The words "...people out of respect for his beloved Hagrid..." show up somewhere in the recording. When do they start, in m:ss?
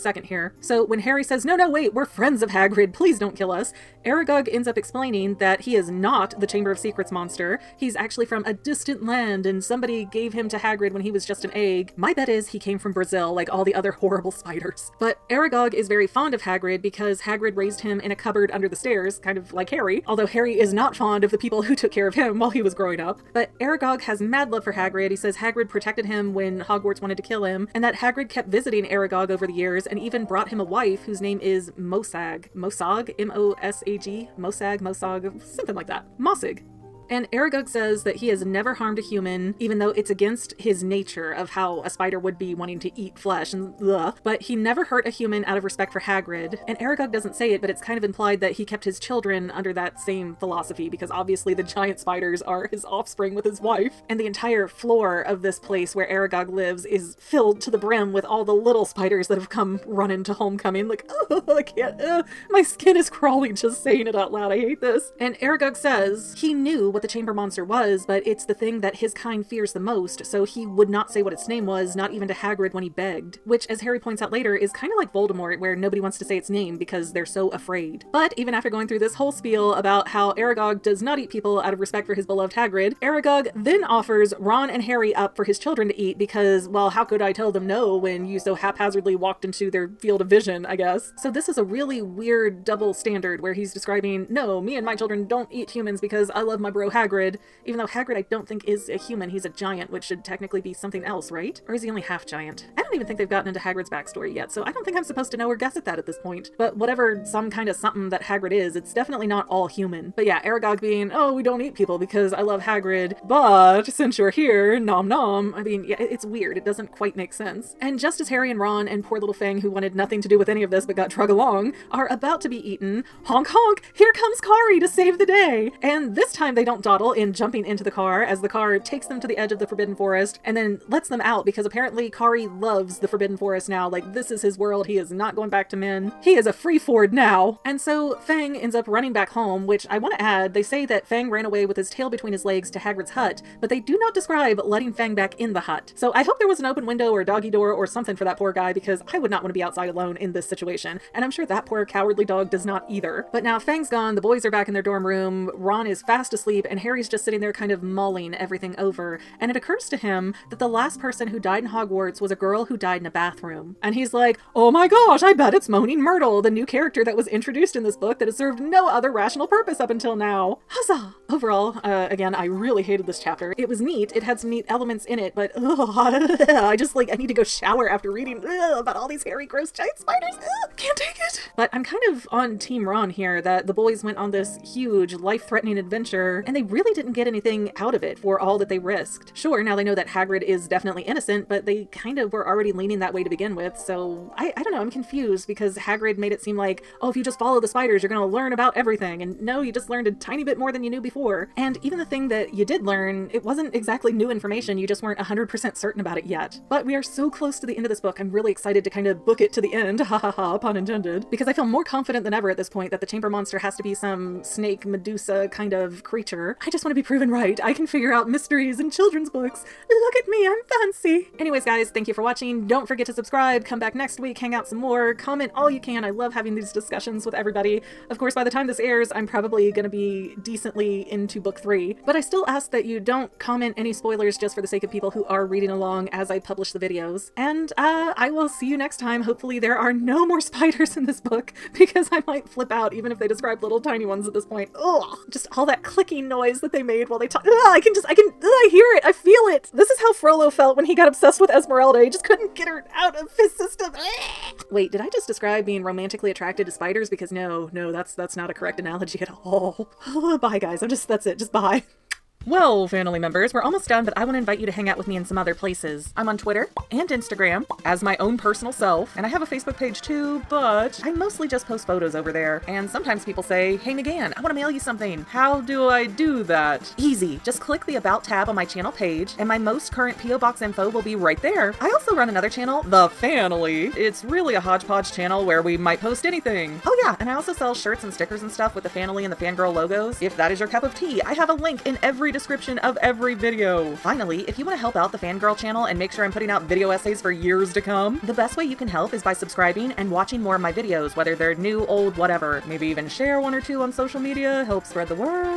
1:21.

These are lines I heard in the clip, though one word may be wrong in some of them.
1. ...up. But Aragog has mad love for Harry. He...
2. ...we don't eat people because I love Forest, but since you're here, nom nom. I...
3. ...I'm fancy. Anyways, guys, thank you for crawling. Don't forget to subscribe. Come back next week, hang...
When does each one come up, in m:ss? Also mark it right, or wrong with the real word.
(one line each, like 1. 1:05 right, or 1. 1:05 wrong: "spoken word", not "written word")
1. 0:22 wrong: "Hagrid", not "Harry"
2. 1:51 wrong: "Hagrid", not "Forest"
3. 3:40 wrong: "watching", not "crawling".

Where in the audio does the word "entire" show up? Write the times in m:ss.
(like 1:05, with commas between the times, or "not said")
0:54.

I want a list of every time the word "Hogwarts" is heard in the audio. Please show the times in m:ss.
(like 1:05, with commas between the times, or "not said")
0:26, 2:41.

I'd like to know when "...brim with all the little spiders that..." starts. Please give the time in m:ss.
0:57.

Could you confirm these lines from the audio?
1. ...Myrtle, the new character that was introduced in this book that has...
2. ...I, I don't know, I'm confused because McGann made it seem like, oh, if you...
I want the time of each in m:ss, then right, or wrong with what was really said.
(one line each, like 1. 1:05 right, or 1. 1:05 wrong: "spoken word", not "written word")
1. 2:46 right
2. 3:14 wrong: "Hagrid", not "McGann".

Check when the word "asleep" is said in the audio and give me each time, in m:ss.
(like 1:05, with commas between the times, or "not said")
2:36.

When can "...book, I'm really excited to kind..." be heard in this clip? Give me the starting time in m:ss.
3:27.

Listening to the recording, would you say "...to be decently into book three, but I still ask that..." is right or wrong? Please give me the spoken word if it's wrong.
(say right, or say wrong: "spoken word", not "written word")
right.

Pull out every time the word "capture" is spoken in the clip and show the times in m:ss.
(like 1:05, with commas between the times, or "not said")
not said.